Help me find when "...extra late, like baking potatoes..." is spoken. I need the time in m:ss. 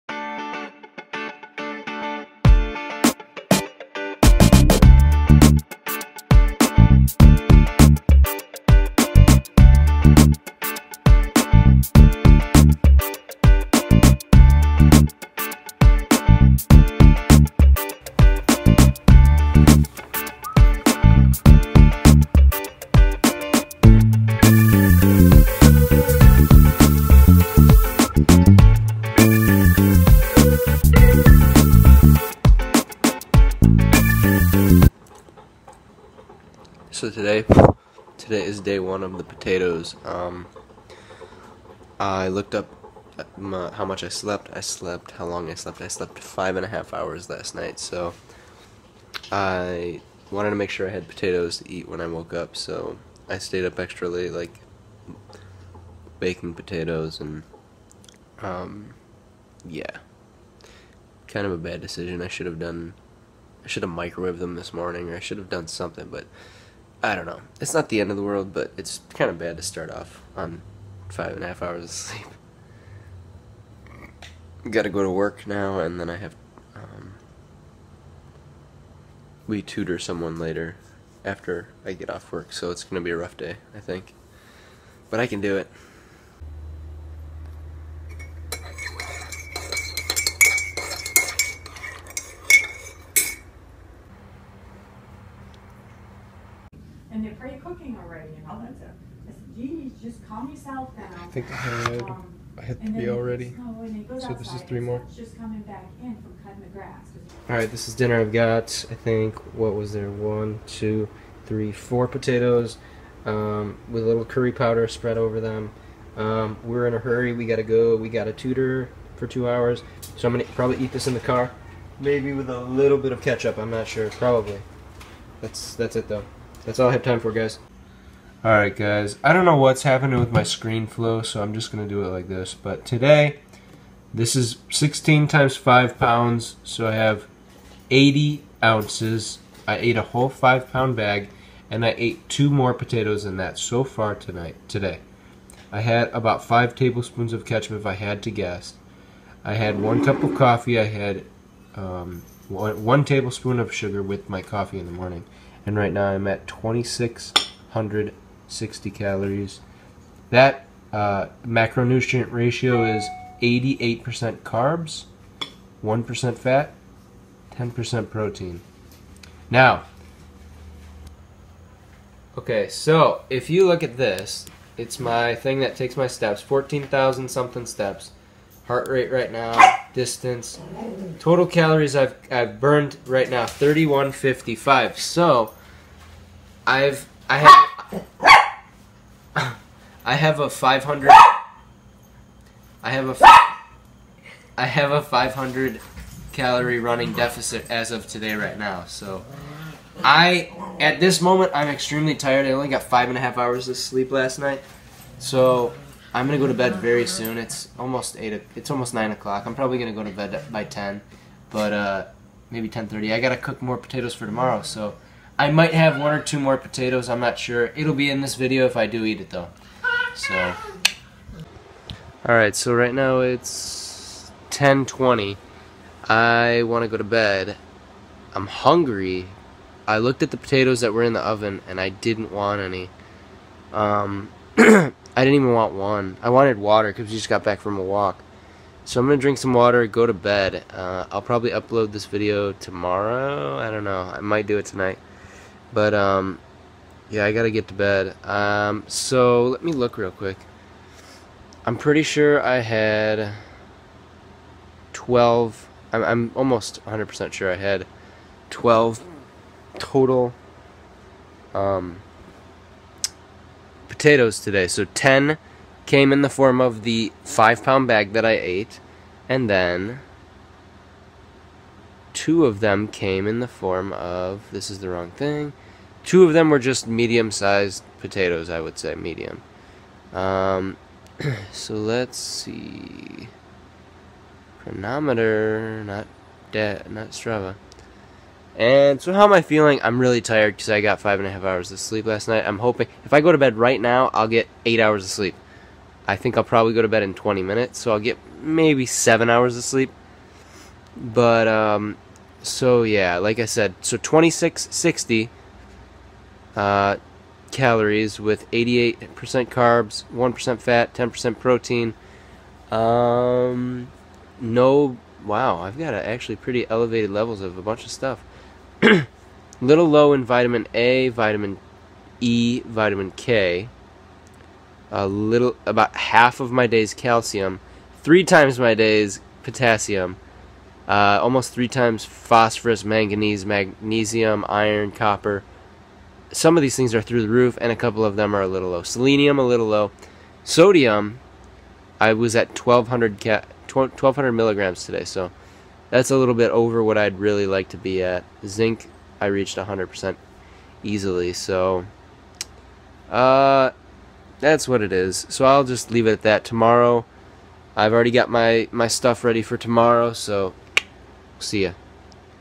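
0:53.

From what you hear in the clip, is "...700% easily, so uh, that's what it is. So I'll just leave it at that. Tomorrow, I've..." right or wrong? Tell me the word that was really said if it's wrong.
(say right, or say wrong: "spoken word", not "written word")
wrong: "100", not "700".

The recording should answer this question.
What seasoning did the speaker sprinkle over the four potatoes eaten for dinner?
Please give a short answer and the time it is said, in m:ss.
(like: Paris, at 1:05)
curry powder, at 1:54.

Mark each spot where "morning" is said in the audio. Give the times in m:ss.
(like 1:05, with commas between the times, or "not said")
1:04, 2:34.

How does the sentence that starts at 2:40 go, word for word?
That uh, macronutrient ratio is 88% carbs, 1% fat, 10% protein.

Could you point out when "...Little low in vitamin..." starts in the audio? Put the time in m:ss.
5:19.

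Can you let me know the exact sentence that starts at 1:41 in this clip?
I think I had, um, I had three already.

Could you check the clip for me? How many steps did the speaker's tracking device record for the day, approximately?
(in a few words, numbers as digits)
14,000.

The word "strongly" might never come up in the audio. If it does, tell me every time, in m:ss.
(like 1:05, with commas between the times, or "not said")
not said.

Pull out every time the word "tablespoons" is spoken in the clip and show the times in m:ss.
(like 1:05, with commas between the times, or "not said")
2:26, 2:33.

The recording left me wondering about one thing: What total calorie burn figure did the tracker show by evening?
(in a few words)
3155.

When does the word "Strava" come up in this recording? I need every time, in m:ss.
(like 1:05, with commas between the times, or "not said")
4:47.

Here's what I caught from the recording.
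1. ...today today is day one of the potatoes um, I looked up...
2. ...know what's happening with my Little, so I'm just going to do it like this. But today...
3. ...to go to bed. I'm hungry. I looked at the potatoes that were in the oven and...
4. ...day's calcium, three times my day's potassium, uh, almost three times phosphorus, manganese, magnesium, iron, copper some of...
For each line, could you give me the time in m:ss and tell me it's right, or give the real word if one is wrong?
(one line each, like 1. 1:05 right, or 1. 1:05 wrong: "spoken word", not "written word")
1. 0:37 right
2. 2:09 wrong: "ScreenFlow", not "Little"
3. 3:46 right
4. 5:26 right.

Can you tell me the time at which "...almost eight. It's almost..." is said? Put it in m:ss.
3:27.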